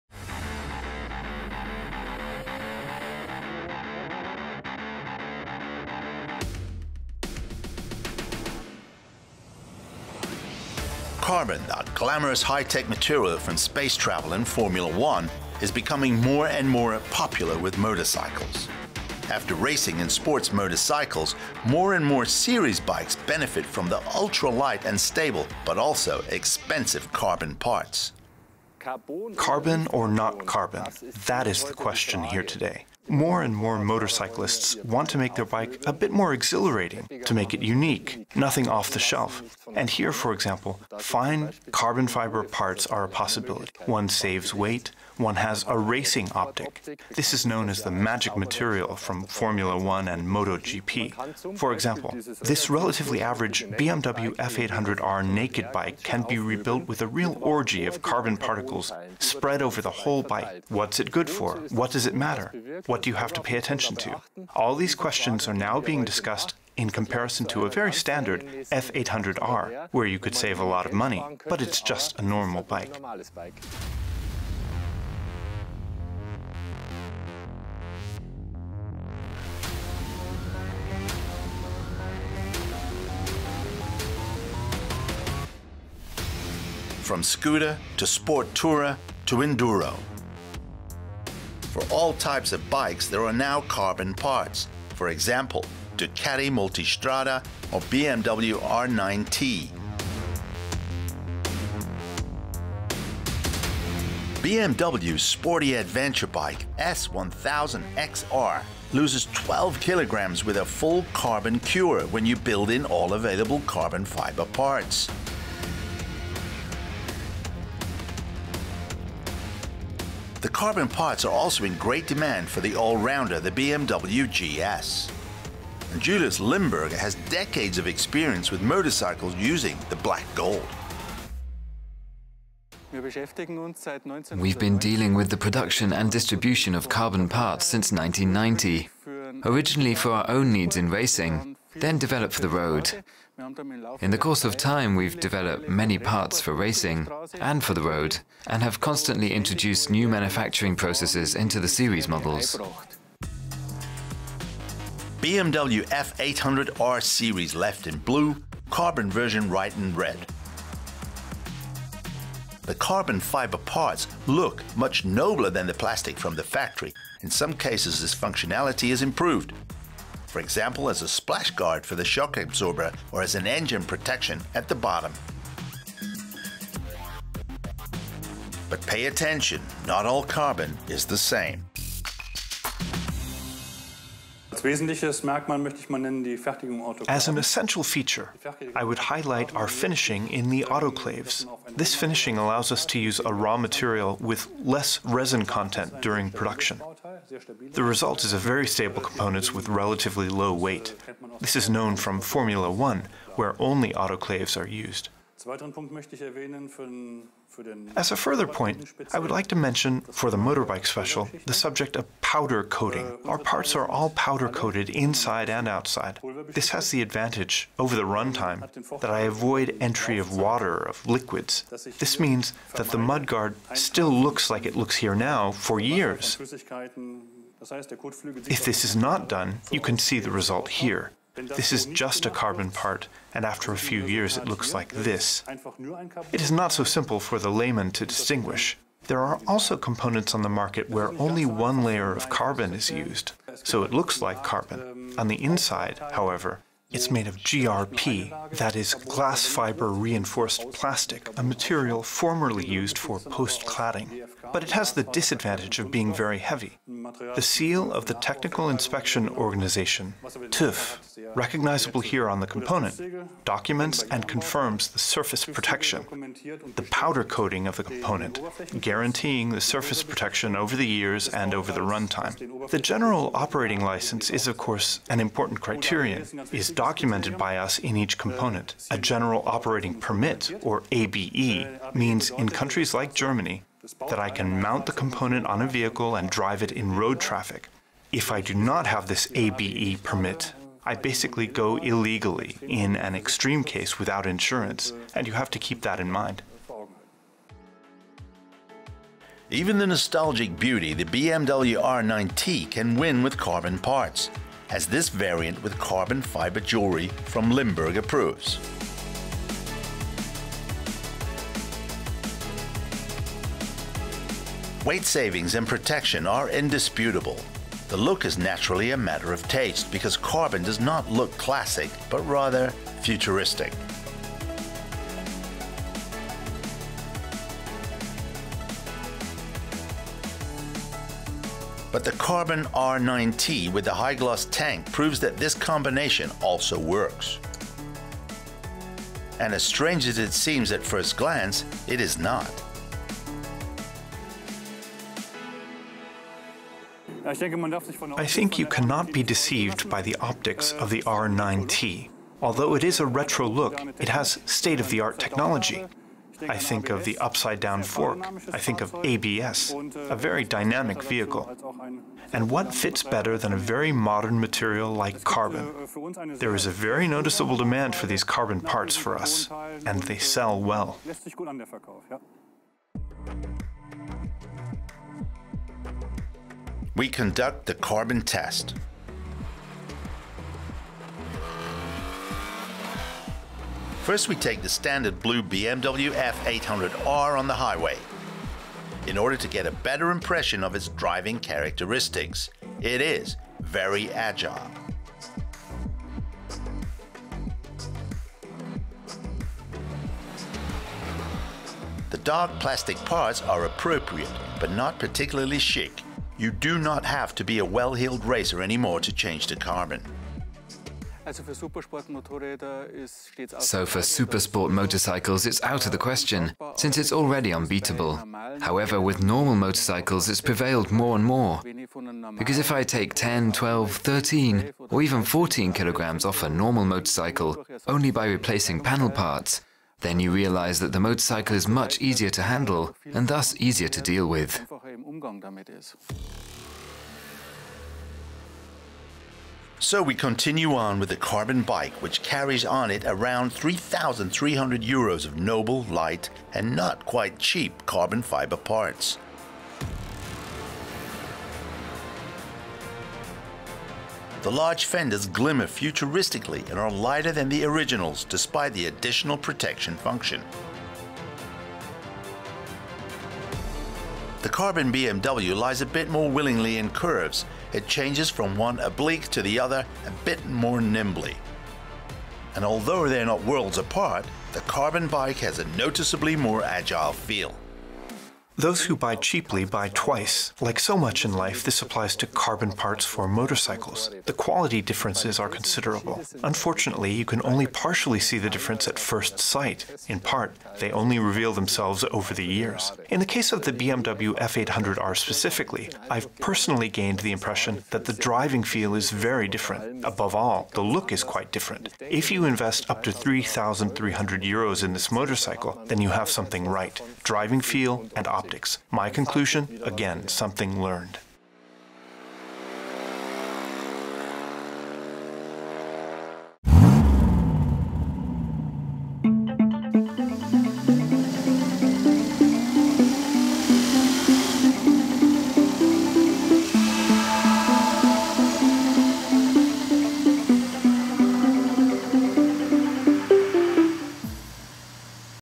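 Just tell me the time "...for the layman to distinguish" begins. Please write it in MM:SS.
03:57.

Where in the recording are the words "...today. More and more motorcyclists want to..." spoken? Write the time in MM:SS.
00:32.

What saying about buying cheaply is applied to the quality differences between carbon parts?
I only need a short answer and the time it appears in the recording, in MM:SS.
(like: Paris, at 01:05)
Those who buy cheaply buy twice, at 07:58.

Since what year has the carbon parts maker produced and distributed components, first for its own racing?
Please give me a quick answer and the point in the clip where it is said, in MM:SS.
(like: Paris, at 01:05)
1990, at 02:17.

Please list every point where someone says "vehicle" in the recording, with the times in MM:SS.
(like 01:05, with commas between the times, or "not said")
04:45, 06:01.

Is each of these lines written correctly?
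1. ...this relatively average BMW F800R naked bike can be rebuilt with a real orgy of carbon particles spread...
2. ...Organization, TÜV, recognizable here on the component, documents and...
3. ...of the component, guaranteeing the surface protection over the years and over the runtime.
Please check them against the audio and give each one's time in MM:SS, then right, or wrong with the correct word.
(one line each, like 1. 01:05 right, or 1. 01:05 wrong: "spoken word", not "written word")
1. 00:52 right
2. 04:19 right
3. 04:27 right.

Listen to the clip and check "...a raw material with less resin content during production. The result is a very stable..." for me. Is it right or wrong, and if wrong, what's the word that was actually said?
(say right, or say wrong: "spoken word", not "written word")
right.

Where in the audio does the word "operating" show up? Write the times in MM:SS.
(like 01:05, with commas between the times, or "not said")
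04:33, 04:39.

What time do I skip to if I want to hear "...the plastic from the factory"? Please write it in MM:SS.
02:45.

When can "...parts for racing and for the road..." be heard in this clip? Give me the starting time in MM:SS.
02:25.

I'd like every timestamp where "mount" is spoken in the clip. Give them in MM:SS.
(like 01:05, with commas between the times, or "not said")
04:44.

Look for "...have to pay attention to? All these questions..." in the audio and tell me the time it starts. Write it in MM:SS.
01:03.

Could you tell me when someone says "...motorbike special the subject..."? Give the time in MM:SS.
03:30.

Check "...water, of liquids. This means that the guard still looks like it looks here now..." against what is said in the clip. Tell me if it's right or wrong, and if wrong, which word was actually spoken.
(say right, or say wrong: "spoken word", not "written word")
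wrong: "mudguard", not "guard".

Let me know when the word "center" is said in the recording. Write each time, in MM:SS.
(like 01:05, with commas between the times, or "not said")
not said.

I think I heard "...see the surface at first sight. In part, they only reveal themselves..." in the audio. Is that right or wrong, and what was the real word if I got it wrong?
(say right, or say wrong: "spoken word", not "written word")
wrong: "difference", not "surface".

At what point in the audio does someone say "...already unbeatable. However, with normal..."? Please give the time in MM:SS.
06:57.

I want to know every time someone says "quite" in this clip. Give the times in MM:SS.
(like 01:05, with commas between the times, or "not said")
07:27, 08:21.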